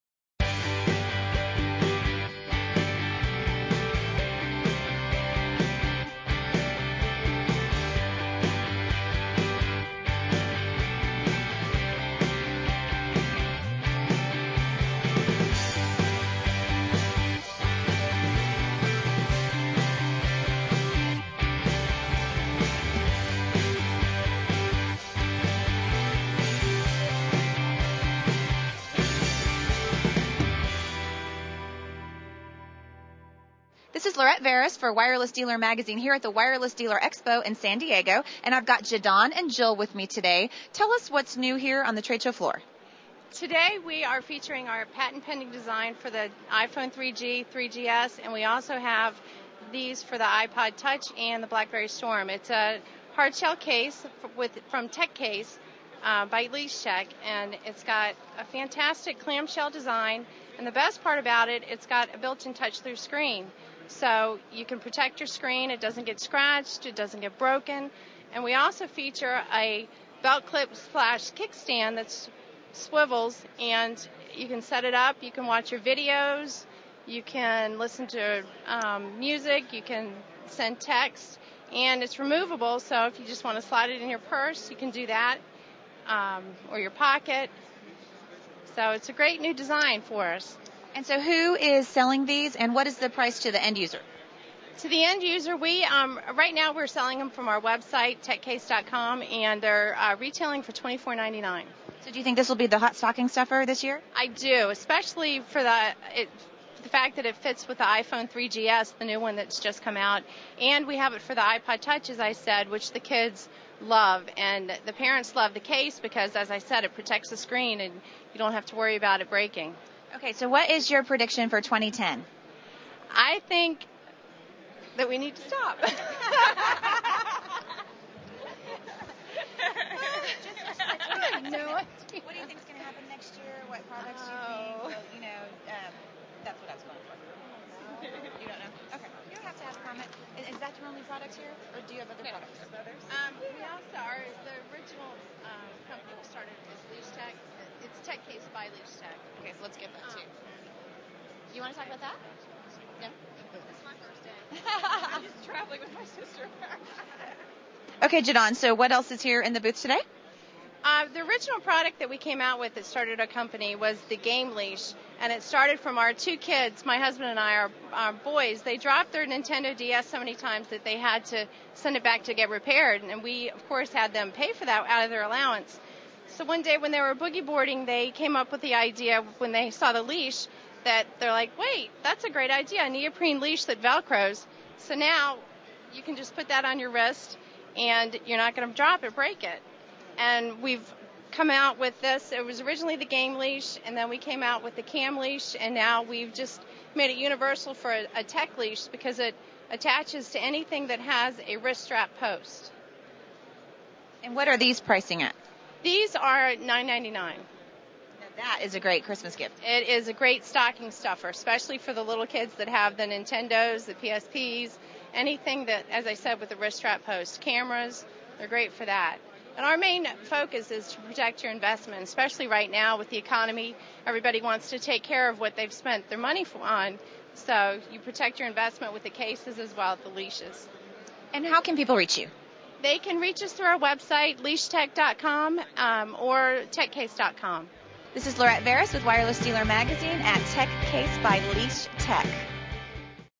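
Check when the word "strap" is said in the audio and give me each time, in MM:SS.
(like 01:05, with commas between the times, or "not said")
03:21, 03:36.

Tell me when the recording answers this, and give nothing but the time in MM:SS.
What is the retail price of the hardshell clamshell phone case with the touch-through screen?
01:40.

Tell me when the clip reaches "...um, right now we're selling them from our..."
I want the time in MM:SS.
01:35.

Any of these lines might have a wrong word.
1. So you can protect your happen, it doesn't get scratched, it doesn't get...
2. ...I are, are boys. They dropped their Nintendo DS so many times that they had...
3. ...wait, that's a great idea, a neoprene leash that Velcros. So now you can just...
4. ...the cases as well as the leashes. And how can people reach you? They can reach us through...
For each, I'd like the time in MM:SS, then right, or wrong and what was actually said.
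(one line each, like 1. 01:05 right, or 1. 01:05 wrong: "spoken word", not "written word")
1. 01:03 wrong: "screen", not "happen"
2. 02:47 right
3. 03:01 right
4. 03:49 right.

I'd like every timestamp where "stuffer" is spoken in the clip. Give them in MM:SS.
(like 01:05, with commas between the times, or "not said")
01:43, 03:30.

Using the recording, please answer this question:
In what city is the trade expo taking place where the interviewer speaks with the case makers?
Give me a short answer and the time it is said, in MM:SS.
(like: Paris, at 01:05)
San Diego, at 00:37.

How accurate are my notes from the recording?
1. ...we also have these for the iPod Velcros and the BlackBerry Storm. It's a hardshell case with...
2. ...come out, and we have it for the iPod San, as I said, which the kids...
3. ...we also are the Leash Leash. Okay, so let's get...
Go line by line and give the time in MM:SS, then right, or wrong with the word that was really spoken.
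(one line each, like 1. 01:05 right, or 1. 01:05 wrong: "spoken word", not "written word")
1. 00:48 wrong: "Touch", not "Velcros"
2. 01:49 wrong: "Touch", not "San"
3. 02:23 wrong: "Tech", not "Leash".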